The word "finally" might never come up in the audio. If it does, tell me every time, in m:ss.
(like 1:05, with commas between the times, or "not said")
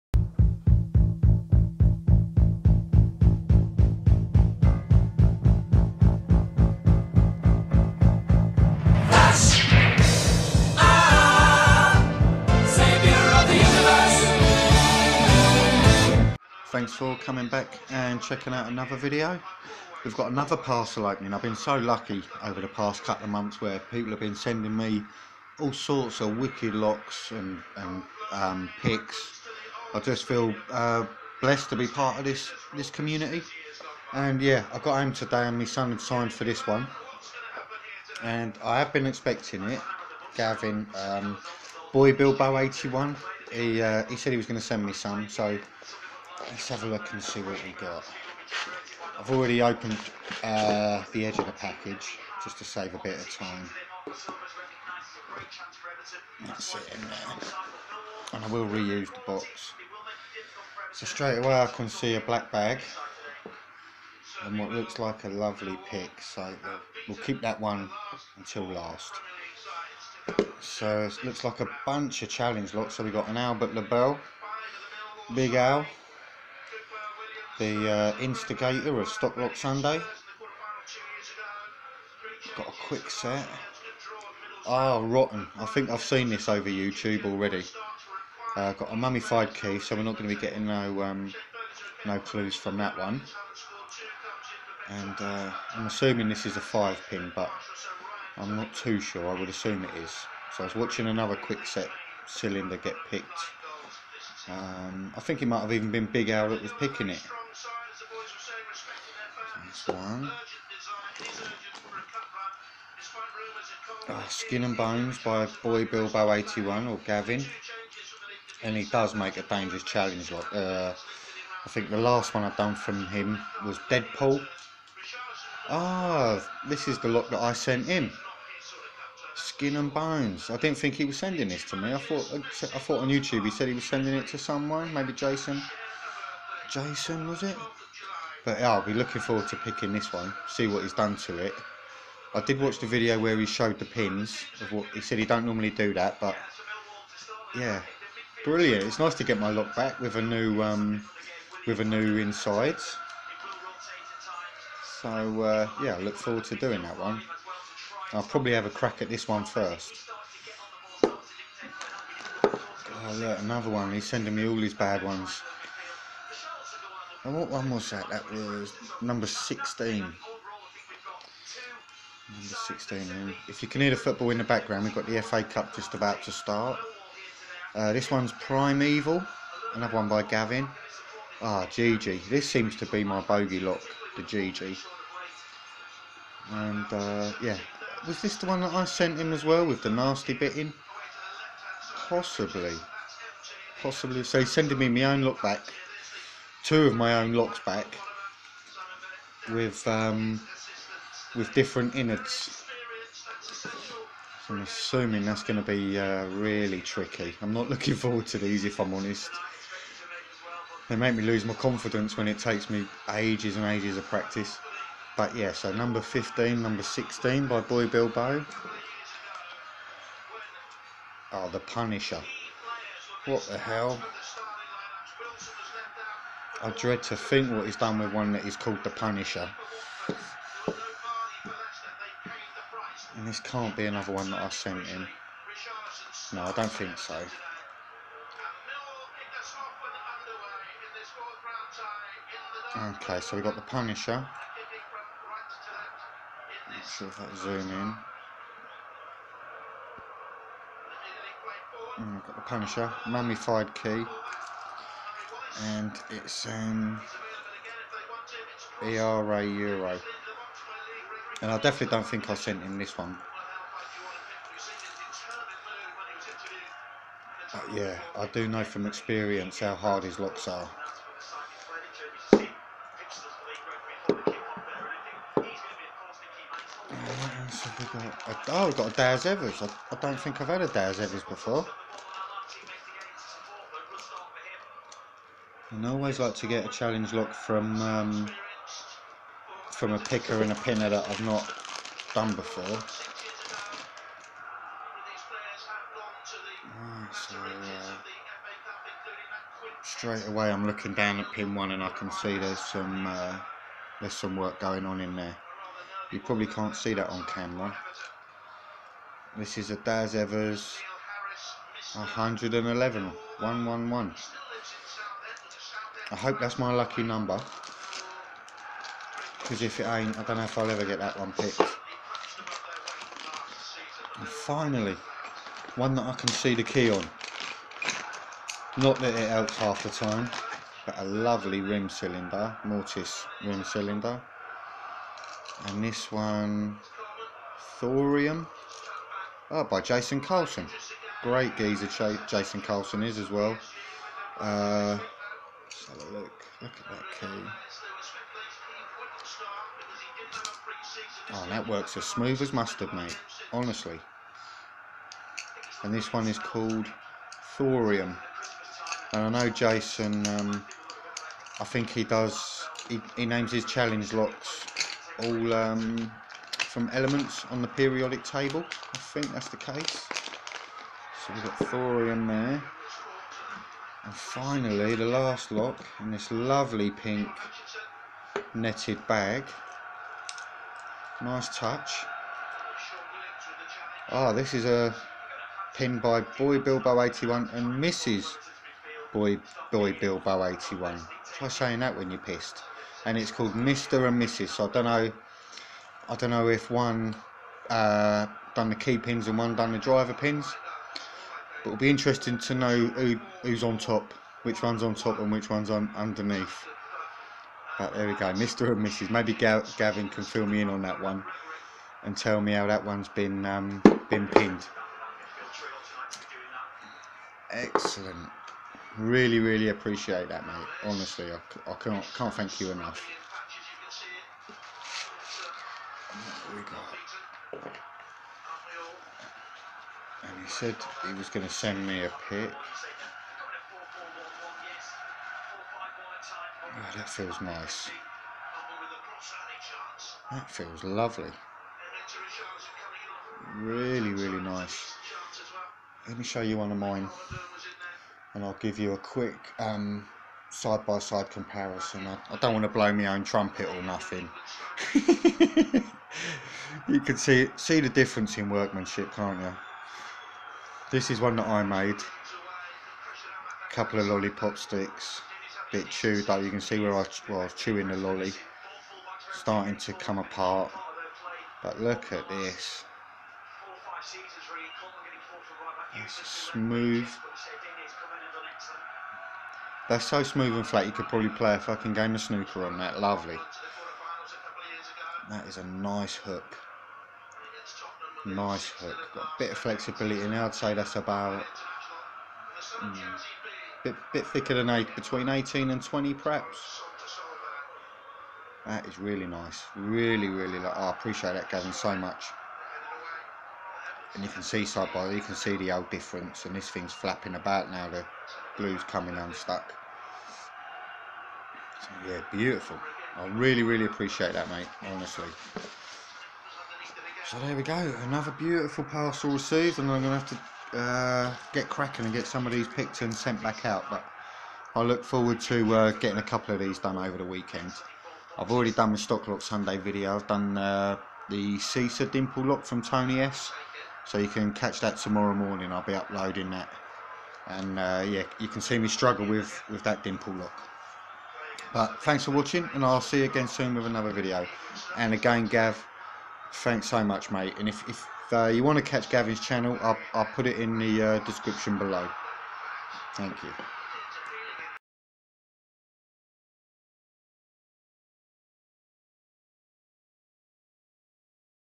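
5:24, 6:14.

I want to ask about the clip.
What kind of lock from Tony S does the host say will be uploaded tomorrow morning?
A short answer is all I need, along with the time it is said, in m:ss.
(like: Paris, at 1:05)
Caesar dimple lock, at 8:51.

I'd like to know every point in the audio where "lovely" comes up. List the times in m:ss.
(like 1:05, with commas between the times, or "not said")
1:05, 5:31, 6:16, 7:20, 8:02.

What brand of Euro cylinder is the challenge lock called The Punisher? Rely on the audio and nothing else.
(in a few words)
ERA.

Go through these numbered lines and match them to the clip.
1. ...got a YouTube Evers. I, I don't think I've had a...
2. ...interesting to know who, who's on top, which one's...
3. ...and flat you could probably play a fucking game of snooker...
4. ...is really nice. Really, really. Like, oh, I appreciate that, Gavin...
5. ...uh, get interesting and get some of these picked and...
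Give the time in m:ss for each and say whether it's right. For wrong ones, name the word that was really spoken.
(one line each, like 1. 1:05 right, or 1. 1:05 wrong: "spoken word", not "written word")
1. 4:38 wrong: "Daz", not "YouTube"
2. 6:41 right
3. 8:00 right
4. 8:18 right
5. 8:40 wrong: "cracking", not "interesting".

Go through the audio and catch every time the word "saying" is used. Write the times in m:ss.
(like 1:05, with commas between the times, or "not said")
6:31.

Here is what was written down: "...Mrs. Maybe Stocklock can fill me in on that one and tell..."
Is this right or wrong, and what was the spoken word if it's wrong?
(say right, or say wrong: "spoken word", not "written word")
wrong: "Gavin", not "Stocklock".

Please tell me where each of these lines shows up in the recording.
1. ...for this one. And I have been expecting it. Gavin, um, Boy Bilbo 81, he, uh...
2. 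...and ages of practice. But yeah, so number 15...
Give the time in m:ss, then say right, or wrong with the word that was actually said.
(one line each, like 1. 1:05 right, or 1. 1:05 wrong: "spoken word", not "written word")
1. 0:36 right
2. 3:33 right.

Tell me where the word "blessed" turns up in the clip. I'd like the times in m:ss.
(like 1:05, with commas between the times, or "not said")
0:31.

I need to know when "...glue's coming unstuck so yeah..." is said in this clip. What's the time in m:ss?
8:28.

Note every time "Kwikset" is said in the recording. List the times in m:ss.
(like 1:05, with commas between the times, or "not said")
1:22, 1:41.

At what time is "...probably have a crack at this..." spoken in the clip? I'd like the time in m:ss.
2:38.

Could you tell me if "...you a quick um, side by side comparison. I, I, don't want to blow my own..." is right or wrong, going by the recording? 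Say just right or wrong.
right.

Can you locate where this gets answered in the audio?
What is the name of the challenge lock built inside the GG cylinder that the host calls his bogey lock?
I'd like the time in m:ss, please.
2:58.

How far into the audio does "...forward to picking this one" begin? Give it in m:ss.
2:19.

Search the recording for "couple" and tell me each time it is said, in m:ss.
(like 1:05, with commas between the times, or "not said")
0:23, 7:43, 8:46.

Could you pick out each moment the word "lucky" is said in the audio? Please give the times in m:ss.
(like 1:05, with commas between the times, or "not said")
0:21, 5:16.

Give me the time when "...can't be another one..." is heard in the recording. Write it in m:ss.
3:53.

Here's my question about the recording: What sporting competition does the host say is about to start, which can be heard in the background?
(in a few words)
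FA Cup.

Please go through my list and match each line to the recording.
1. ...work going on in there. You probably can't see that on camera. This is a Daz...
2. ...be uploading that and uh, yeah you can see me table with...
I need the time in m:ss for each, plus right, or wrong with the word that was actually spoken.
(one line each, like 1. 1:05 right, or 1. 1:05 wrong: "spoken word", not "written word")
1. 5:04 right
2. 8:55 wrong: "struggle", not "table".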